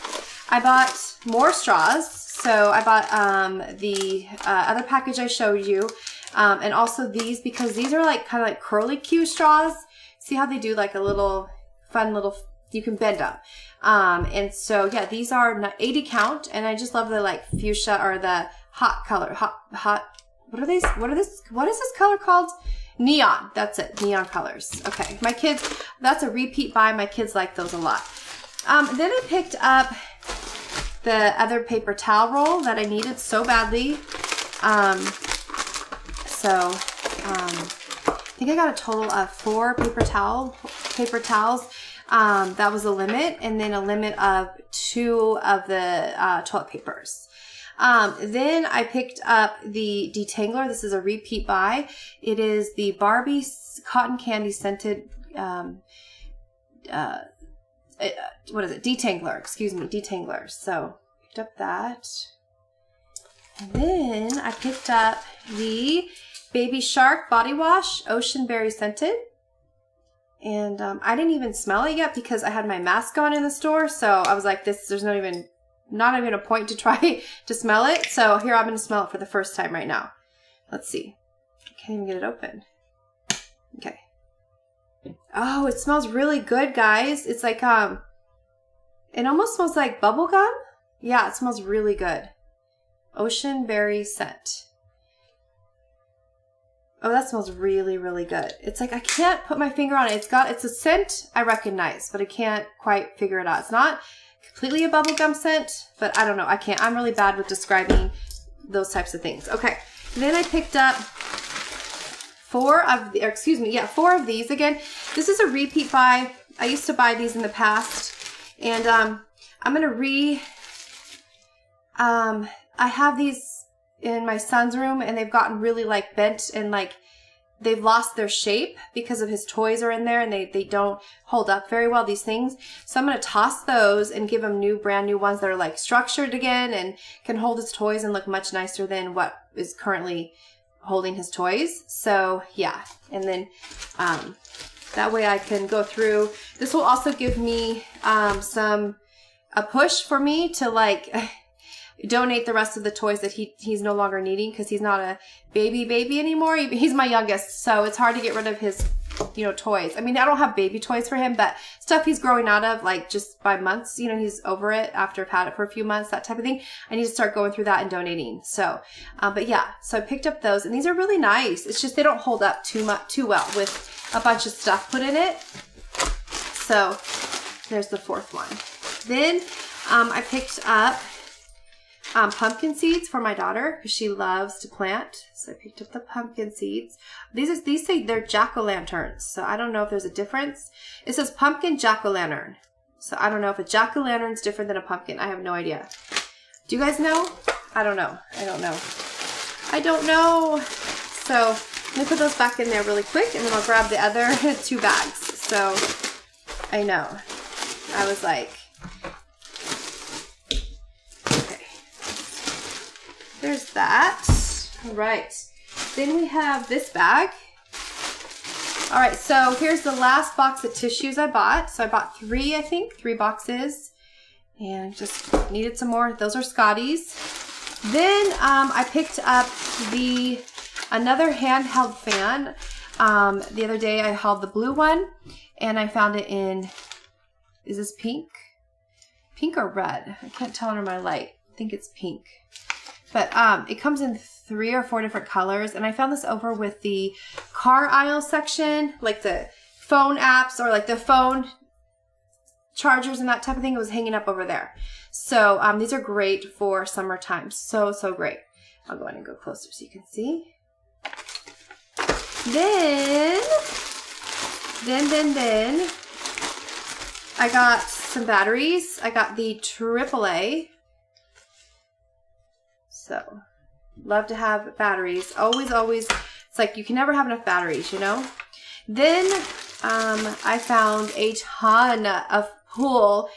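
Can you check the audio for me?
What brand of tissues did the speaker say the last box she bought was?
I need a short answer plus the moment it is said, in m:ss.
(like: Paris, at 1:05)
Scotties, at 3:46.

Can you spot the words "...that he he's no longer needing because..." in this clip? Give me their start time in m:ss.
2:33.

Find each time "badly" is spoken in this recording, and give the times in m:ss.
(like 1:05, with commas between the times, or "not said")
0:33.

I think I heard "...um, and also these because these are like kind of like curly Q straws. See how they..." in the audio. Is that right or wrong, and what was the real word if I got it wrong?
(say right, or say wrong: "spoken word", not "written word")
right.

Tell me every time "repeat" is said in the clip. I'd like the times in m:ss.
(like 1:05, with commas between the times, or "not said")
0:26, 0:51, 1:55.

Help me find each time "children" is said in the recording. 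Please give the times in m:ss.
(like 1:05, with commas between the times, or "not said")
not said.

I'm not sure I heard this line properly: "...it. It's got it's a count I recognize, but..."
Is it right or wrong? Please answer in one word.
wrong.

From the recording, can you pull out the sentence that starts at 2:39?
I mean, I don't have baby toys for him, but stuff he's growing out of like just by months.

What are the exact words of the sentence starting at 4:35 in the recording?
Always, always, it's like you can never have enough batteries, you know?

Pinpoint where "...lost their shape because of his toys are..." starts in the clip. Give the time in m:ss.
2:07.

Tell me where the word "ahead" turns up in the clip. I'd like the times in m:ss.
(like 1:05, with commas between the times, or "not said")
4:19.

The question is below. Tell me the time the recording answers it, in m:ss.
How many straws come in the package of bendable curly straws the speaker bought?
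0:15.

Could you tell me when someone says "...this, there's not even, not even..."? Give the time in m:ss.
1:14.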